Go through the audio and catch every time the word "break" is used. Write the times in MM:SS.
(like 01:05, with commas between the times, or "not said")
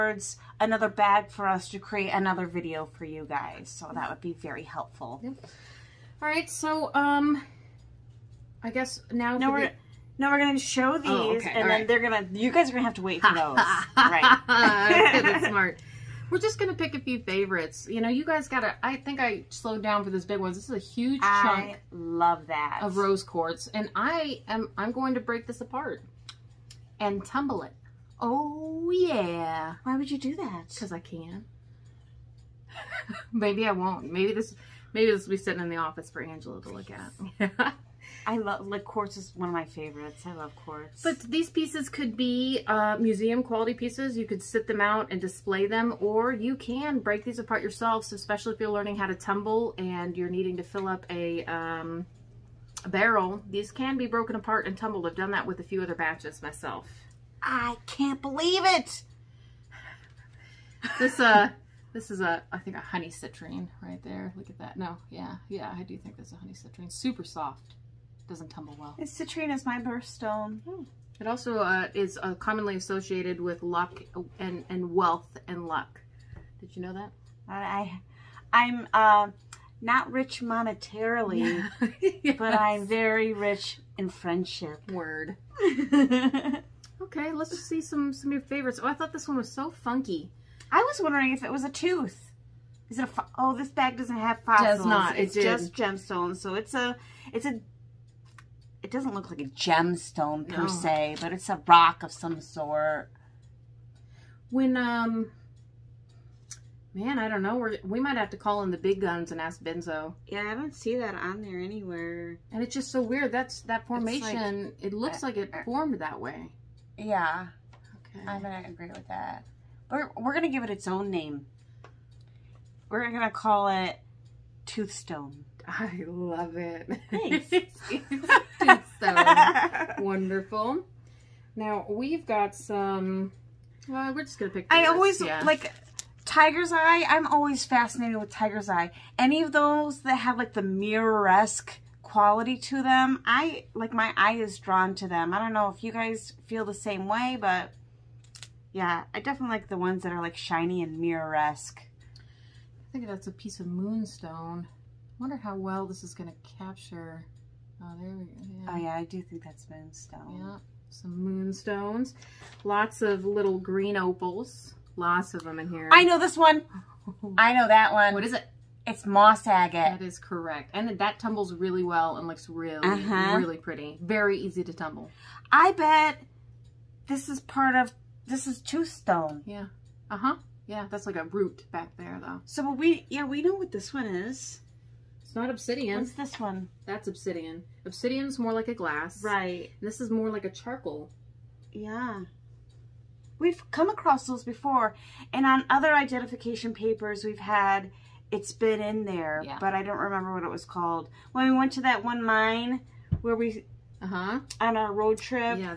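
00:25, 00:46.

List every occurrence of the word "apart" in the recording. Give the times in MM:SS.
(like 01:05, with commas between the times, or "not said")
00:25, 00:47, 00:54.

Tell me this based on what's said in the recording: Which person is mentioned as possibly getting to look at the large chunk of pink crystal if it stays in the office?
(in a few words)
Angela.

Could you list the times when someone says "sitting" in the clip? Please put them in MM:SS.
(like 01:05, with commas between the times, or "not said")
00:35.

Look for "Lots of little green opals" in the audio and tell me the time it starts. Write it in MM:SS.
02:42.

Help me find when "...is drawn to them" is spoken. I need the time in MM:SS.
02:24.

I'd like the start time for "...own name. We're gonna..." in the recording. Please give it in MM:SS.
02:00.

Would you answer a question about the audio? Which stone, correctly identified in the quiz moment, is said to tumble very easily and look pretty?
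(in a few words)
Moss agate.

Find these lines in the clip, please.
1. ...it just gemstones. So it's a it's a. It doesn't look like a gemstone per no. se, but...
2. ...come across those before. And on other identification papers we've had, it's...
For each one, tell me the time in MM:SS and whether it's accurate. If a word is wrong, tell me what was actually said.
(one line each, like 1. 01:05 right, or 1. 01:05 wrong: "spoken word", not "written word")
1. 01:35 right
2. 03:13 right.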